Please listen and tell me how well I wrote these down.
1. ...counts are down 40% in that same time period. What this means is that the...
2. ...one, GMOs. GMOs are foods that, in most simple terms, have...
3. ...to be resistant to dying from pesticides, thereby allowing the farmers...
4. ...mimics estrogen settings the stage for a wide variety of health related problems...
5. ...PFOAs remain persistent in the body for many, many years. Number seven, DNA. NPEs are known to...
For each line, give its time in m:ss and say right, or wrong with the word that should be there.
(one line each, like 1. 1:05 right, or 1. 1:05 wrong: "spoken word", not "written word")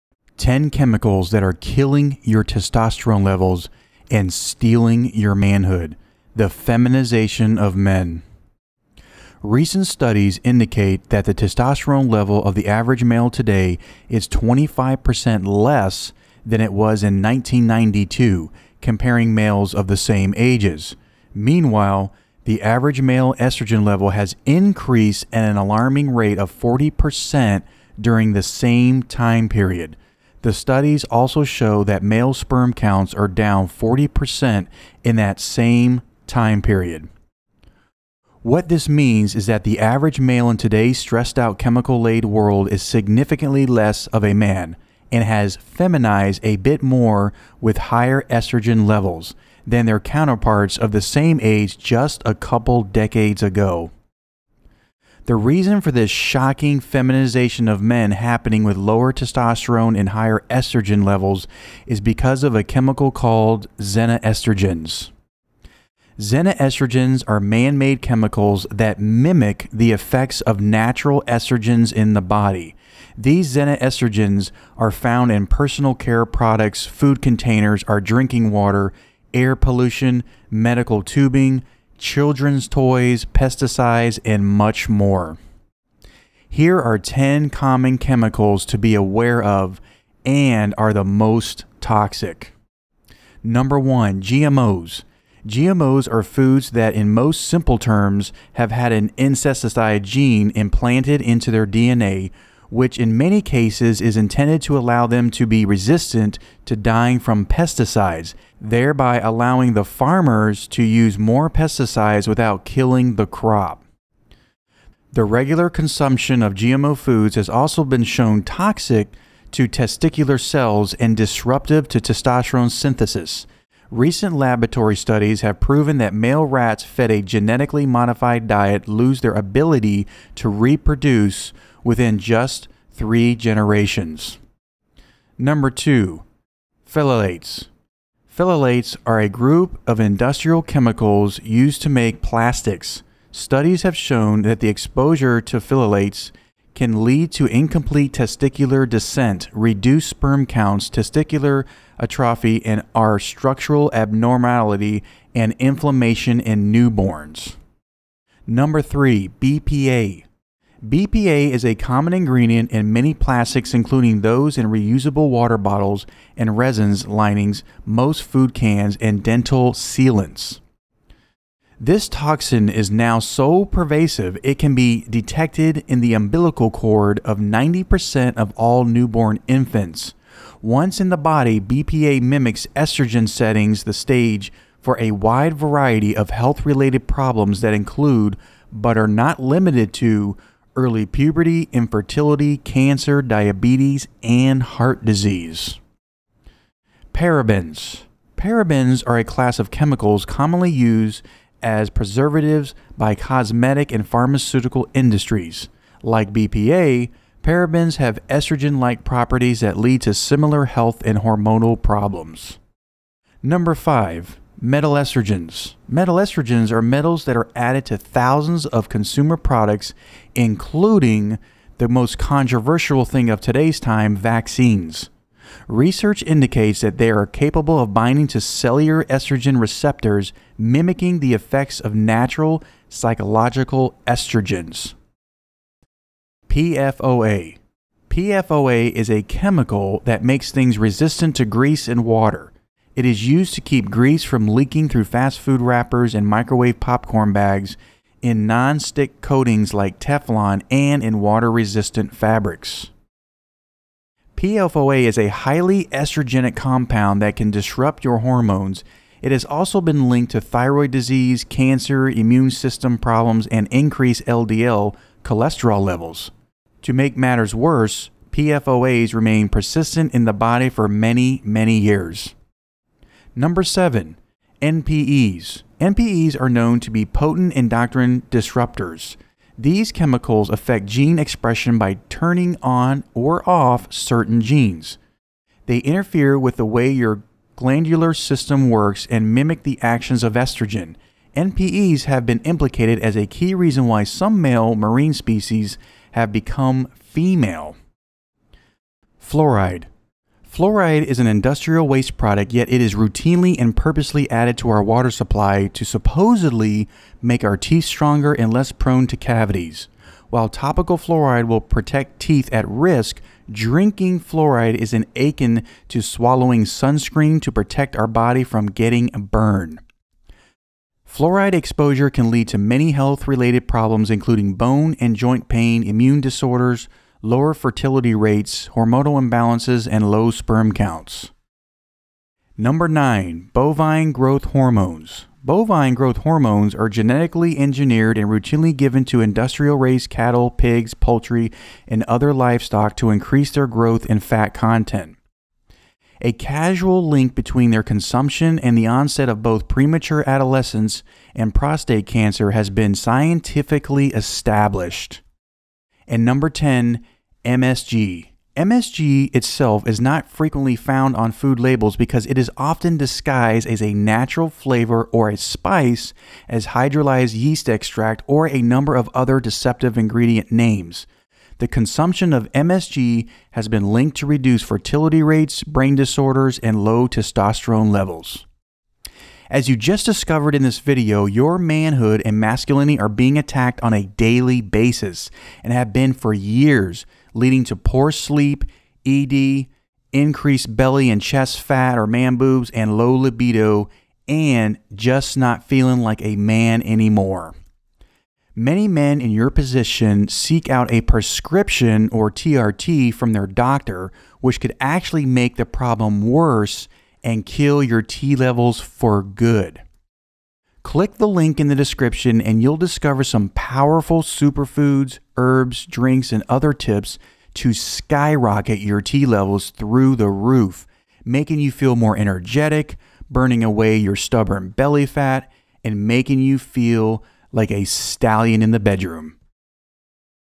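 1. 0:32 right
2. 1:33 right
3. 1:45 right
4. 3:02 right
5. 4:28 wrong: "NPEs", not "DNA".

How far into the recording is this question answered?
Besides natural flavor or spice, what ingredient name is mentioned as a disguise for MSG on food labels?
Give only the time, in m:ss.
6:06.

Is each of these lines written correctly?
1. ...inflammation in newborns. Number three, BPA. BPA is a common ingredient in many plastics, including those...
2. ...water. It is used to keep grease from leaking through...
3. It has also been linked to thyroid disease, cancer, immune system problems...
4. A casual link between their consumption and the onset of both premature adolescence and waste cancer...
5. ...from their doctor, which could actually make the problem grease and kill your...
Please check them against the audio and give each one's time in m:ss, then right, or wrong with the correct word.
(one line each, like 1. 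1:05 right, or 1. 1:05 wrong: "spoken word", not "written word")
1. 2:35 right
2. 4:02 right
3. 4:19 right
4. 5:46 wrong: "prostate", not "waste"
5. 6:43 wrong: "worse", not "grease".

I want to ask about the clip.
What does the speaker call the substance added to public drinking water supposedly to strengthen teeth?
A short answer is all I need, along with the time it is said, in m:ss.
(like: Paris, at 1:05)
industrial waste product, at 5:01.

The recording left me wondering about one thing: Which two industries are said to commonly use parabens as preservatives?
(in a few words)
cosmetic and pharmaceutical.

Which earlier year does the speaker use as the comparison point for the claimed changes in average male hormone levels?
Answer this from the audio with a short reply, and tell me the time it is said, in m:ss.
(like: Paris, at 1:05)
1992, at 0:17.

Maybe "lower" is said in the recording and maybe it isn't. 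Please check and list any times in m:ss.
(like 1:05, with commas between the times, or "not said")
0:58, 5:27.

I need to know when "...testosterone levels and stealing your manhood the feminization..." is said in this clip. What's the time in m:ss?
0:02.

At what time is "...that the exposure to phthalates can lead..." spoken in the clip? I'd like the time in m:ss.
2:24.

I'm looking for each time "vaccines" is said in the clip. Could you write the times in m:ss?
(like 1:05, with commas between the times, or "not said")
3:44.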